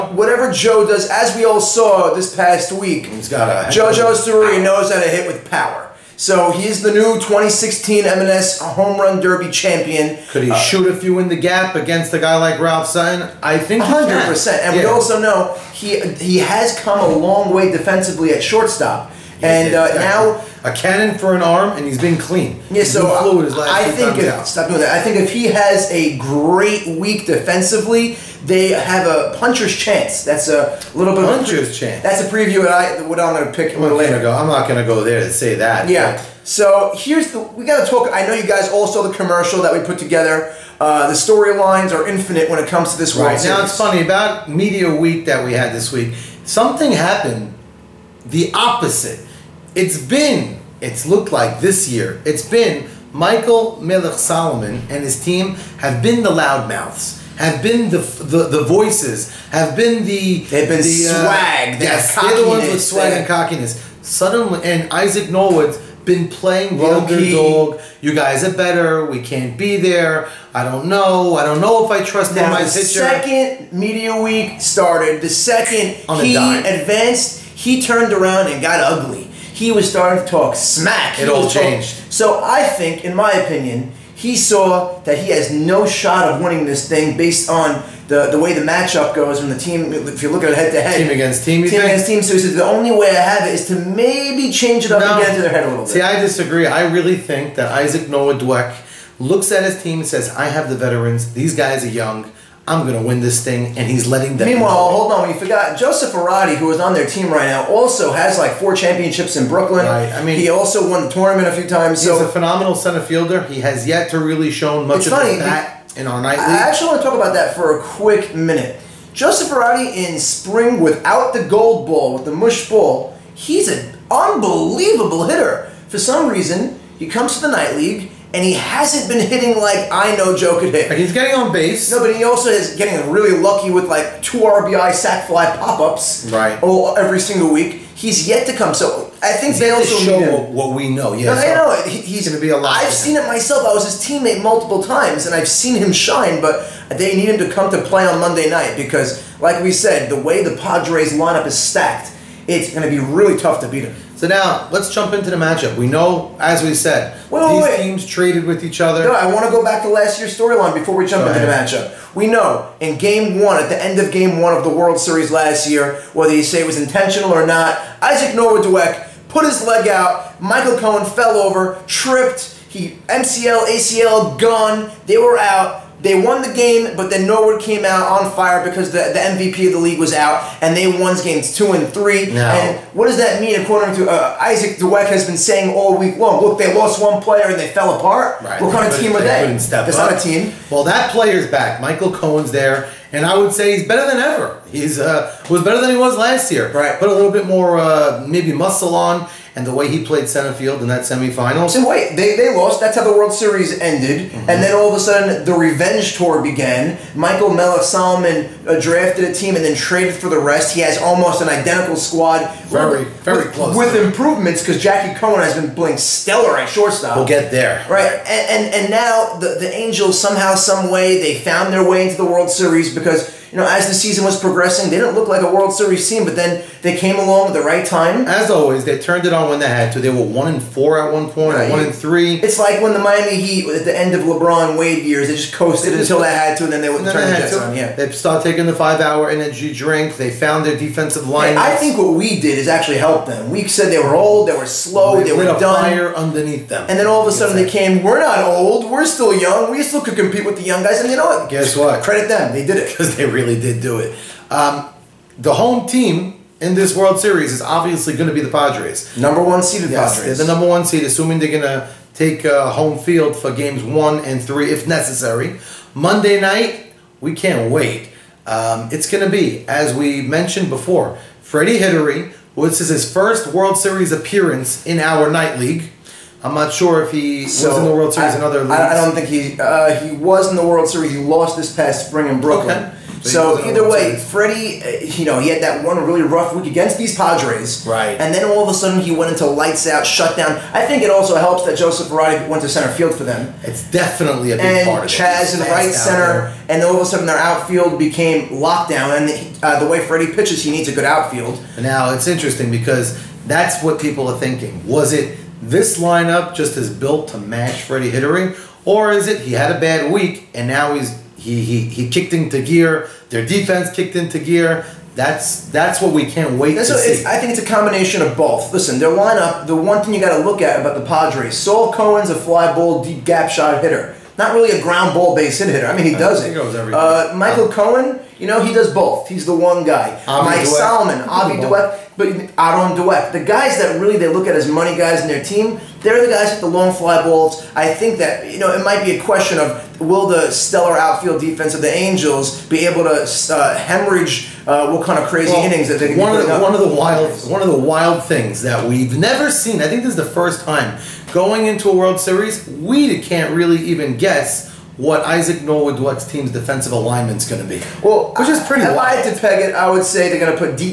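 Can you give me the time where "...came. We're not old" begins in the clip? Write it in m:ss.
4:07.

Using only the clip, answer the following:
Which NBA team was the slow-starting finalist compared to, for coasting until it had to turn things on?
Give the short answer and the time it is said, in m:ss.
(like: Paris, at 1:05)
Miami Heat, at 3:52.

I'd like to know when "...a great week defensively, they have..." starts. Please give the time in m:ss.
0:25.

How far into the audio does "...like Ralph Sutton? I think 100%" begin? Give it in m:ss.
0:12.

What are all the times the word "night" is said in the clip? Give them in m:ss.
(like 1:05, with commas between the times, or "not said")
2:07, 2:28, 4:26, 4:35.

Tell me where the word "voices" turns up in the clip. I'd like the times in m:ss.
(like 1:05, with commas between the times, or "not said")
0:58.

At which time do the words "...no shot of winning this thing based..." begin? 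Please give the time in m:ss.
1:25.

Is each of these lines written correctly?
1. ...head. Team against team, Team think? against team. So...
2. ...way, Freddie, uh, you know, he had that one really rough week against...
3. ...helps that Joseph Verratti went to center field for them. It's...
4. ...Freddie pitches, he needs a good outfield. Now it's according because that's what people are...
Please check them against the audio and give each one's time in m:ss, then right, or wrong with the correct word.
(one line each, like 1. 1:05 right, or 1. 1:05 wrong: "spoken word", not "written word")
1. 1:30 right
2. 4:43 right
3. 4:51 right
4. 5:00 wrong: "interesting", not "according".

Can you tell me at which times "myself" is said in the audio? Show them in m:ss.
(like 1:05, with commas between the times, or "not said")
2:23.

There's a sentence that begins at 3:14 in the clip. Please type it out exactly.
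He's uh, was better than he was last year.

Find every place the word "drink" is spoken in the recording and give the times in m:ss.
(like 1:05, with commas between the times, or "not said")
3:59.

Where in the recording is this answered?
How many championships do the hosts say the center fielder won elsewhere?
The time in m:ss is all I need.
1:48.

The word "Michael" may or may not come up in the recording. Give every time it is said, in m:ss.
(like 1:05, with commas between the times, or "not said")
0:53, 2:50, 3:11, 3:27, 5:27.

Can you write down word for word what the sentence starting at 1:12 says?
My the second media week started.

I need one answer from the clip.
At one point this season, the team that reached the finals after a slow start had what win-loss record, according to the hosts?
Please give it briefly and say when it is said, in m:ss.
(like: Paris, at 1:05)
1 and 4, at 3:50.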